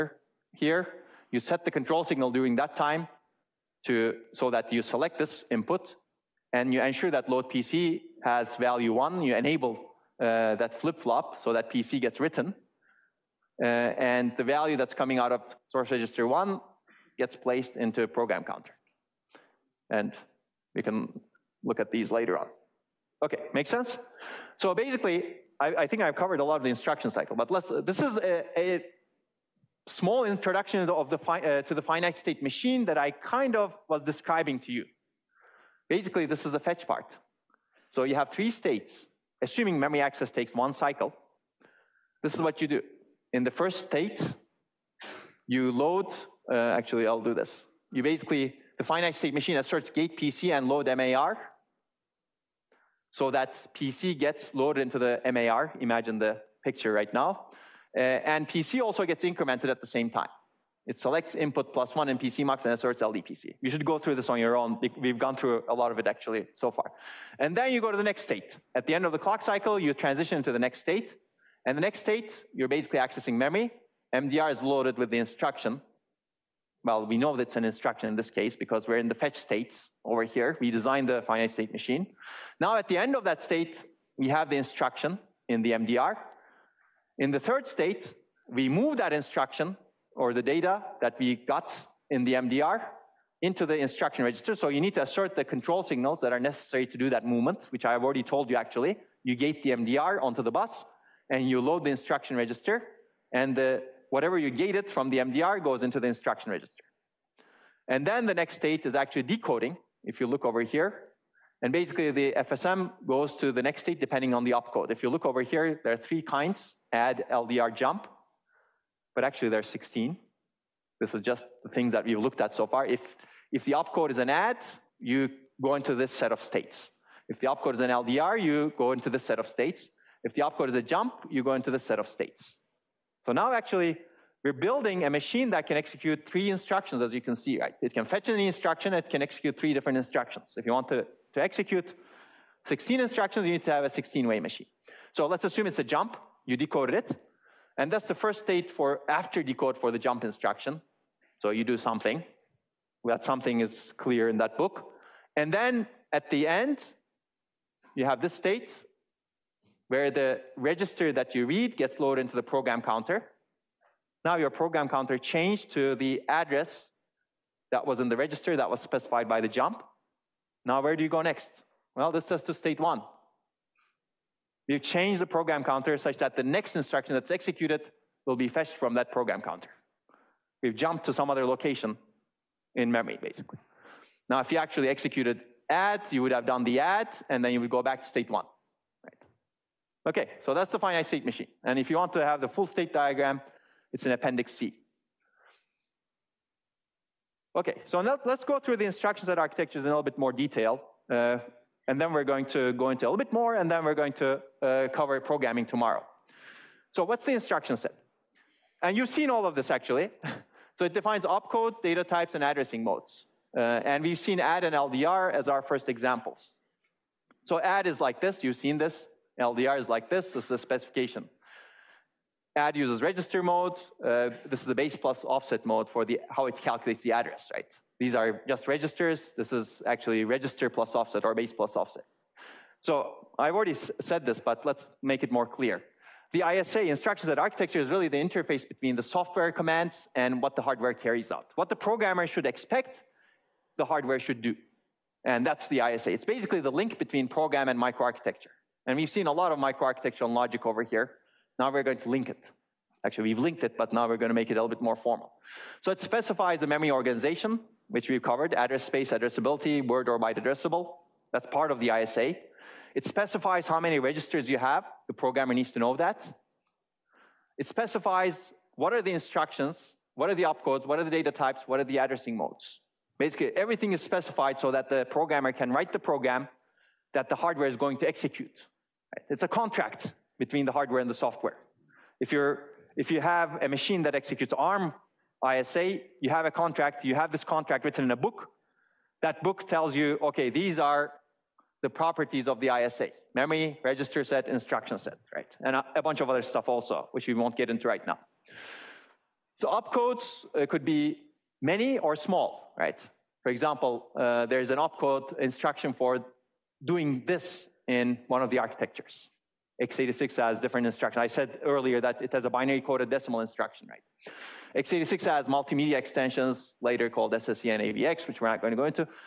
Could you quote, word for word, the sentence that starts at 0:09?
You enable uh, that flip-flop so that PC gets written.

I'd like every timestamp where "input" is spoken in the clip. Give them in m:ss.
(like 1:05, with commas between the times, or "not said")
0:05, 1:01.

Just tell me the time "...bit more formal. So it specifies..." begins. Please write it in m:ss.
4:14.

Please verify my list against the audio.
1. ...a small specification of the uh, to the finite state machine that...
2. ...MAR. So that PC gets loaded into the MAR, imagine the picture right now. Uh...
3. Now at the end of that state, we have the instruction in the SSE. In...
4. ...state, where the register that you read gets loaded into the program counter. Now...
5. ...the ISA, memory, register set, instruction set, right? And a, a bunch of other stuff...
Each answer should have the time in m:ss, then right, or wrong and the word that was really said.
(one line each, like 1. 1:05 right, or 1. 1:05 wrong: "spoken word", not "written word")
1. 0:28 wrong: "introduction", not "specification"
2. 0:50 right
3. 1:22 wrong: "MDR", not "SSE"
4. 2:38 right
5. 4:52 right.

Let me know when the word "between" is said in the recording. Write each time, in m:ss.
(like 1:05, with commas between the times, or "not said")
3:58, 4:06, 4:40.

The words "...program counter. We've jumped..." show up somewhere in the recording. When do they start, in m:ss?
2:59.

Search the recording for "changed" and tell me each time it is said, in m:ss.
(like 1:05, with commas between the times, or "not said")
2:45, 2:54.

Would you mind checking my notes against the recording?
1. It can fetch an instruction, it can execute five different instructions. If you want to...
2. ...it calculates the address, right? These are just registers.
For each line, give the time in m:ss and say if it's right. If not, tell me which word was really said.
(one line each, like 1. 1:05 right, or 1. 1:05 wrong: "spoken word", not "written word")
1. 2:17 wrong: "three", not "five"
2. 3:46 right.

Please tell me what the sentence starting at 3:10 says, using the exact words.
Okay, so that's the finite state machine.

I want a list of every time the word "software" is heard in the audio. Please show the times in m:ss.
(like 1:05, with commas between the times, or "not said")
3:59, 4:41.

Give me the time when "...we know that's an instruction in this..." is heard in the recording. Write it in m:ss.
1:17.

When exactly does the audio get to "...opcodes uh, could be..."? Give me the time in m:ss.
4:59.